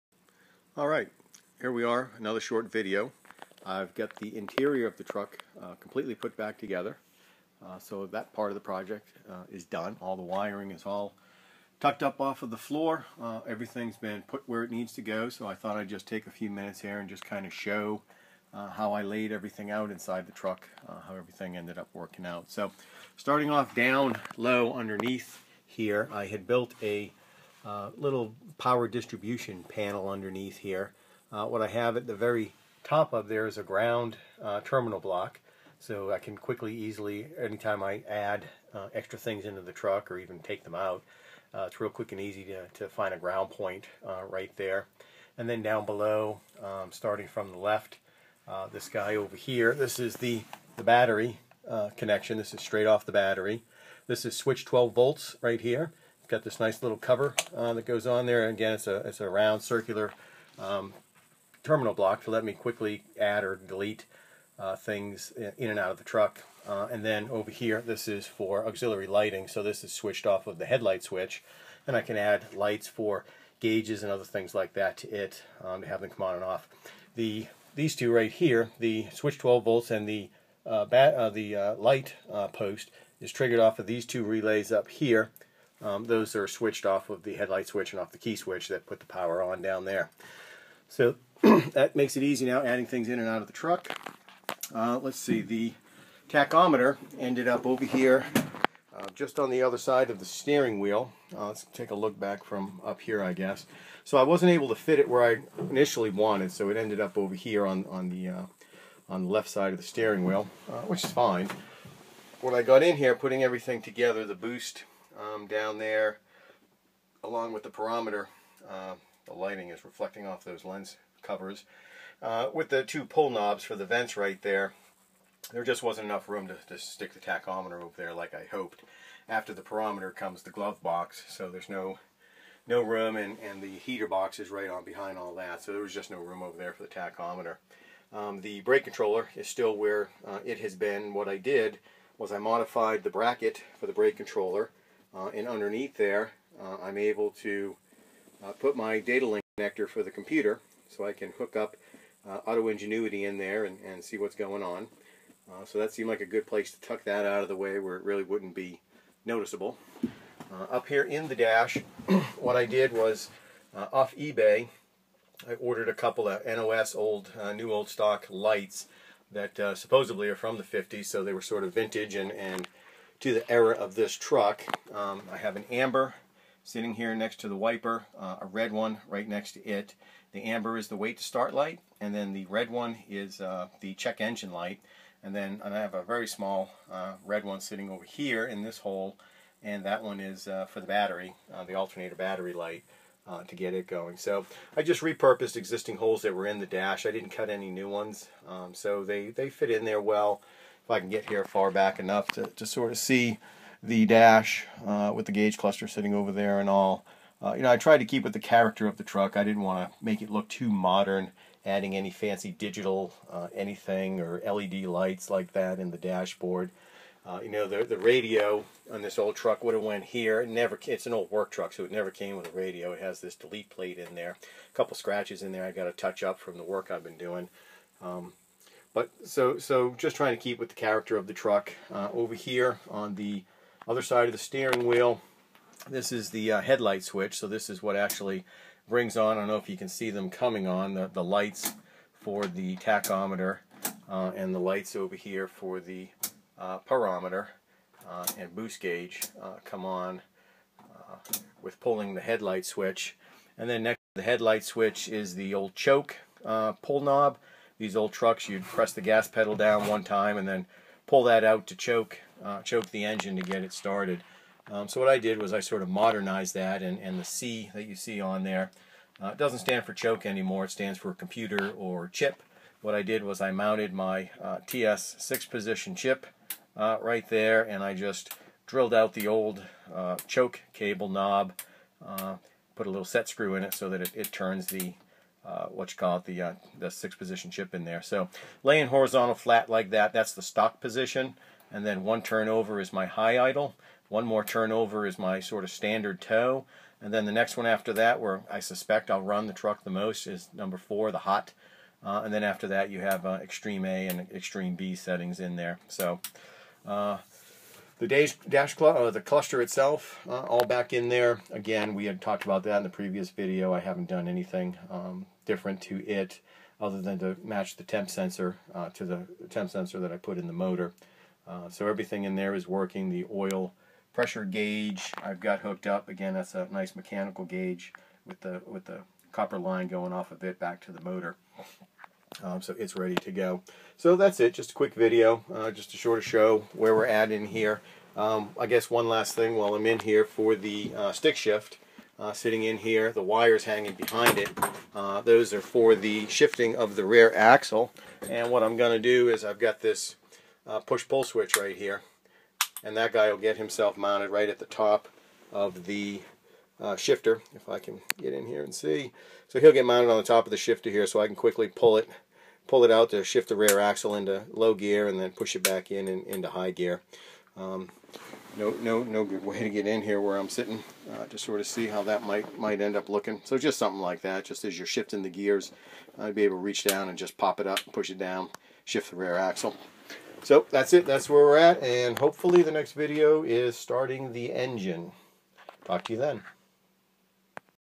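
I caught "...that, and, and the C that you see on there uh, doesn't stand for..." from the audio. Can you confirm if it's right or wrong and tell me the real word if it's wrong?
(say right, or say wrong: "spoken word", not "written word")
right.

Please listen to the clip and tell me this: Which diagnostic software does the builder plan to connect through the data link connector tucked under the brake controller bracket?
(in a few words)
Auto Ingenuity.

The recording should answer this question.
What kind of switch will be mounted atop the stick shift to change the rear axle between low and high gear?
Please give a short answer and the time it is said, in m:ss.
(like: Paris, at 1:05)
Push-pull switch, at 5:50.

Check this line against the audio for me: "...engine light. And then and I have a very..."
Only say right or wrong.
right.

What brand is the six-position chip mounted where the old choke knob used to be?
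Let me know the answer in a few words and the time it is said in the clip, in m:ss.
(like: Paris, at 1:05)
TS, at 4:34.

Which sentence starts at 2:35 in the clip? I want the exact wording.
so that seemed like a good place to tuck that out of the way where it really wouldn't be noticeable.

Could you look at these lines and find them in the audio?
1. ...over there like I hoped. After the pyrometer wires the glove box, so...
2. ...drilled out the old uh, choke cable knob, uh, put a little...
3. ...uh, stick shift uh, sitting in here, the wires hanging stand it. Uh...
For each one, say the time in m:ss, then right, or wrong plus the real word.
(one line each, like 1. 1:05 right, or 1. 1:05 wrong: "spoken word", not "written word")
1. 2:07 wrong: "comes", not "wires"
2. 4:38 right
3. 5:40 wrong: "behind", not "stand".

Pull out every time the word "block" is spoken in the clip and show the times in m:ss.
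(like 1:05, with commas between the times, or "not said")
0:34, 1:01.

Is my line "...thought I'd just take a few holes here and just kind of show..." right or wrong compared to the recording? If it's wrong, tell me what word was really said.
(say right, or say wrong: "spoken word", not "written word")
wrong: "minutes", not "holes".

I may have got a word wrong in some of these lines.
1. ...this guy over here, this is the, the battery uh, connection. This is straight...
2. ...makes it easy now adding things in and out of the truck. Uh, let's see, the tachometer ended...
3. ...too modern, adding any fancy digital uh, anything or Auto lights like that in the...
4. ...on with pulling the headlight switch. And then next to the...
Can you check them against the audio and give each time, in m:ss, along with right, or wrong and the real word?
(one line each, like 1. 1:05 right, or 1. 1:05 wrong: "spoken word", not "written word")
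1. 0:48 right
2. 1:31 right
3. 3:30 wrong: "LED", not "Auto"
4. 4:09 right.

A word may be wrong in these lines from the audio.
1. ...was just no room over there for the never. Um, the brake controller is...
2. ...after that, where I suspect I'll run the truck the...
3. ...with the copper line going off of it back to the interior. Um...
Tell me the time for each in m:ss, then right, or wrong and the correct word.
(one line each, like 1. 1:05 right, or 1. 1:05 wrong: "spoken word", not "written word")
1. 2:15 wrong: "tachometer", not "never"
2. 4:57 right
3. 5:28 wrong: "motor", not "interior".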